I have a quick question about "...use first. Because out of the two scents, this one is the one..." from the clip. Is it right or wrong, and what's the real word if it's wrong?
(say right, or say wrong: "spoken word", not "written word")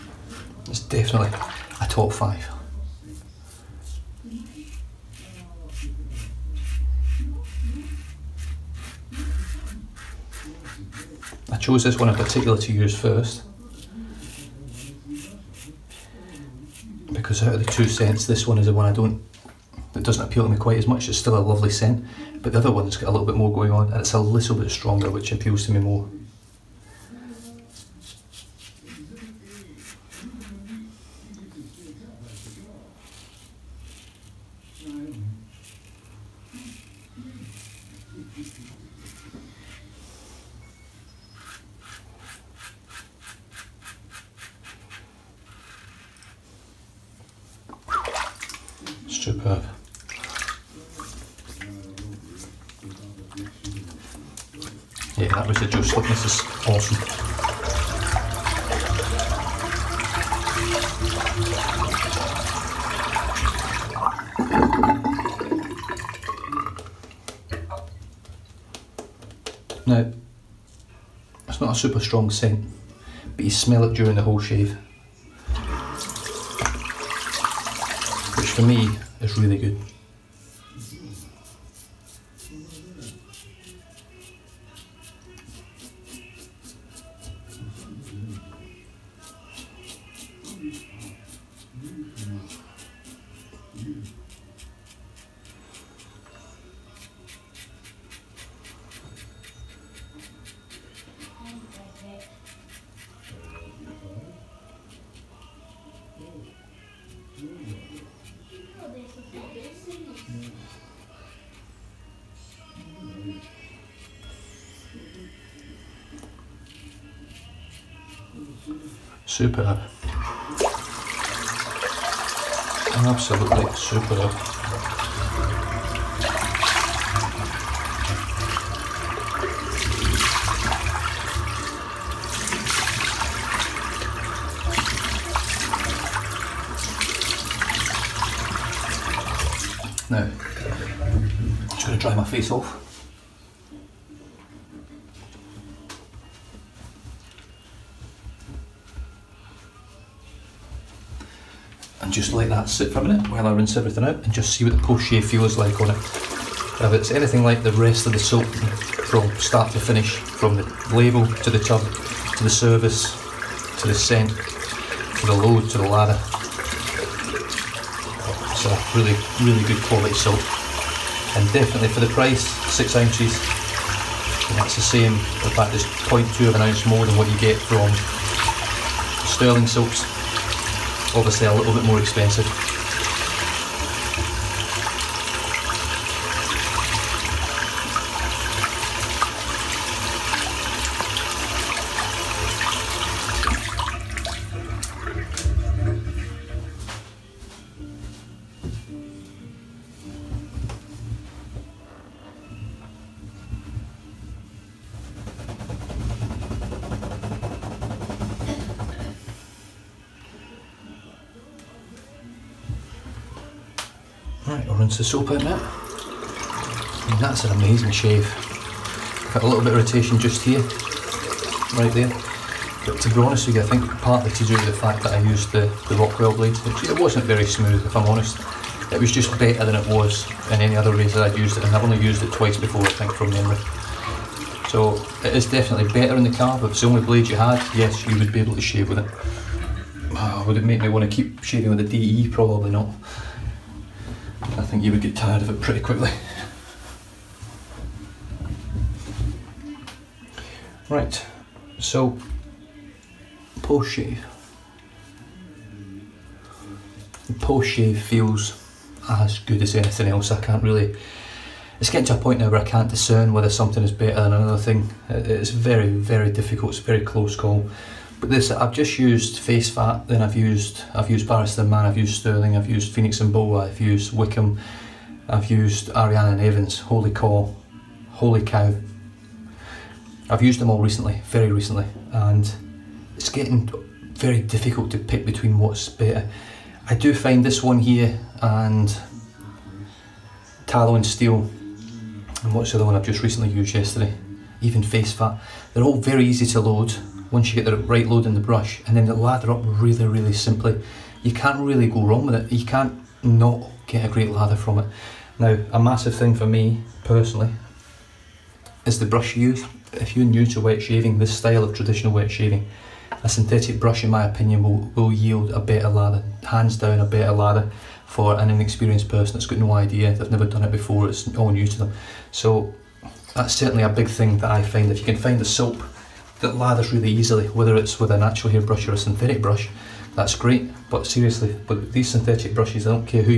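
right.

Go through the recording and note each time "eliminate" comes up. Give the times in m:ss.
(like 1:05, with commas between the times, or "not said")
not said.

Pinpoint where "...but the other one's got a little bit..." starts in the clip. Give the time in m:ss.
0:22.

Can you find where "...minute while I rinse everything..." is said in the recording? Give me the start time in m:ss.
2:33.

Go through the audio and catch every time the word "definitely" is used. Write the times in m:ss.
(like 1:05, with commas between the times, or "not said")
0:00, 2:51, 3:55.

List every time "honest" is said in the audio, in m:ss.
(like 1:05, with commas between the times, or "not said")
3:43, 3:48.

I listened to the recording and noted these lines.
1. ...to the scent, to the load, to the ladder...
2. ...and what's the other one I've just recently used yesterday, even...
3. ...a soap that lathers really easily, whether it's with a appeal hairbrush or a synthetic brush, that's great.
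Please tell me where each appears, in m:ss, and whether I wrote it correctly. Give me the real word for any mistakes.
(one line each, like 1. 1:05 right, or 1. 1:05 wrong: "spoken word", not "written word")
1. 2:43 right
2. 4:52 right
3. 5:25 wrong: "natural", not "appeal".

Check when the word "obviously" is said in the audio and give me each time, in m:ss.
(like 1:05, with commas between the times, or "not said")
3:01.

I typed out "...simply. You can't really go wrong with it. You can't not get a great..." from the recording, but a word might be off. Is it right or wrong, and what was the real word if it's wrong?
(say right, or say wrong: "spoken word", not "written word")
right.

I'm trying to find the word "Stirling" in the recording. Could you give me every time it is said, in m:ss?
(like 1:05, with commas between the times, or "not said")
2:59, 4:32.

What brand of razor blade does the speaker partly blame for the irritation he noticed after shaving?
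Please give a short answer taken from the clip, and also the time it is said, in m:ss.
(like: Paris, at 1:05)
Rockwell, at 3:45.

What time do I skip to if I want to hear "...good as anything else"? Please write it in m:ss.
4:19.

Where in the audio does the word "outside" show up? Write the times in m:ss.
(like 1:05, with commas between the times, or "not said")
not said.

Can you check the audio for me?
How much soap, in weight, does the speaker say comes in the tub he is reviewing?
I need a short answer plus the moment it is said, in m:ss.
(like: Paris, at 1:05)
6 ounces, at 2:52.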